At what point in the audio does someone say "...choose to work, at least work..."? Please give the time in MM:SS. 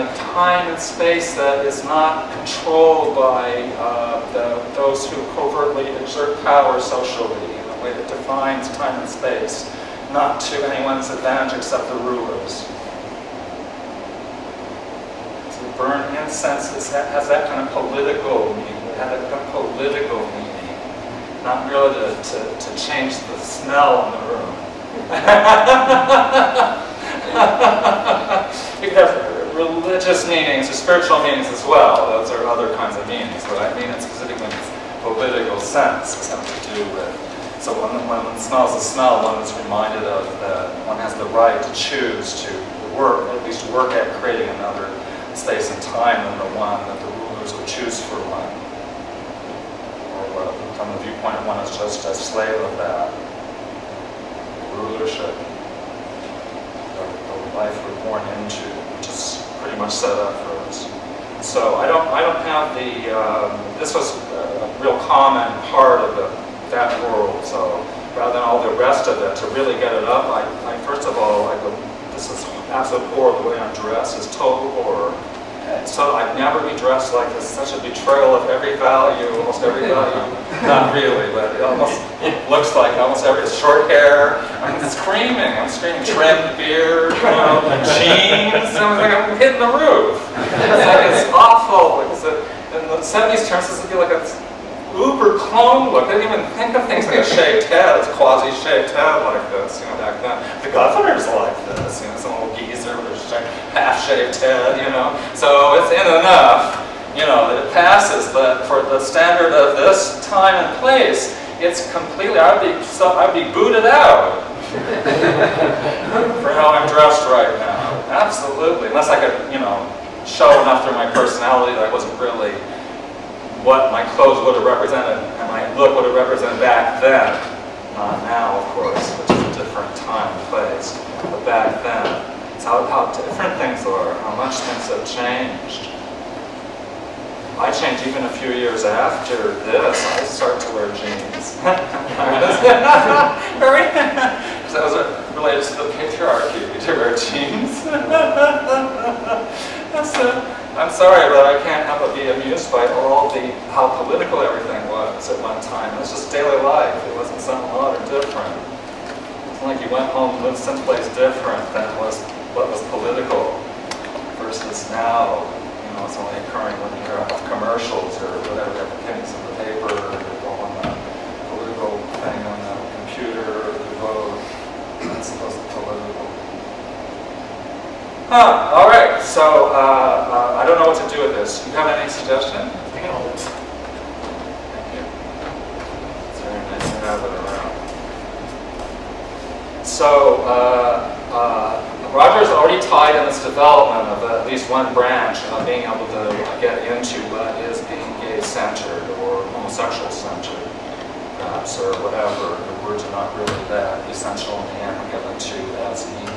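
00:41.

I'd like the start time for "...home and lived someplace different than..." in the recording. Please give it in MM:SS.
02:40.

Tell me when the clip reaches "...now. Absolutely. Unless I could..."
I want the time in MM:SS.
01:57.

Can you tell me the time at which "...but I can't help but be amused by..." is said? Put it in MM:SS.
02:31.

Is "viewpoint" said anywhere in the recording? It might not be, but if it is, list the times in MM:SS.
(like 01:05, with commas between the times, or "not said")
00:51.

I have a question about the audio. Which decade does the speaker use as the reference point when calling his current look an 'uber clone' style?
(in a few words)
the 70s.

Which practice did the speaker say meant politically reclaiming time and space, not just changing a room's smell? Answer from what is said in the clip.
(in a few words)
burn incense.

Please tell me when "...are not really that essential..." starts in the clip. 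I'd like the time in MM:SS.
03:23.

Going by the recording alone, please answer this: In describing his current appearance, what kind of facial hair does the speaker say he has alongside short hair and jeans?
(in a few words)
trimmed beard.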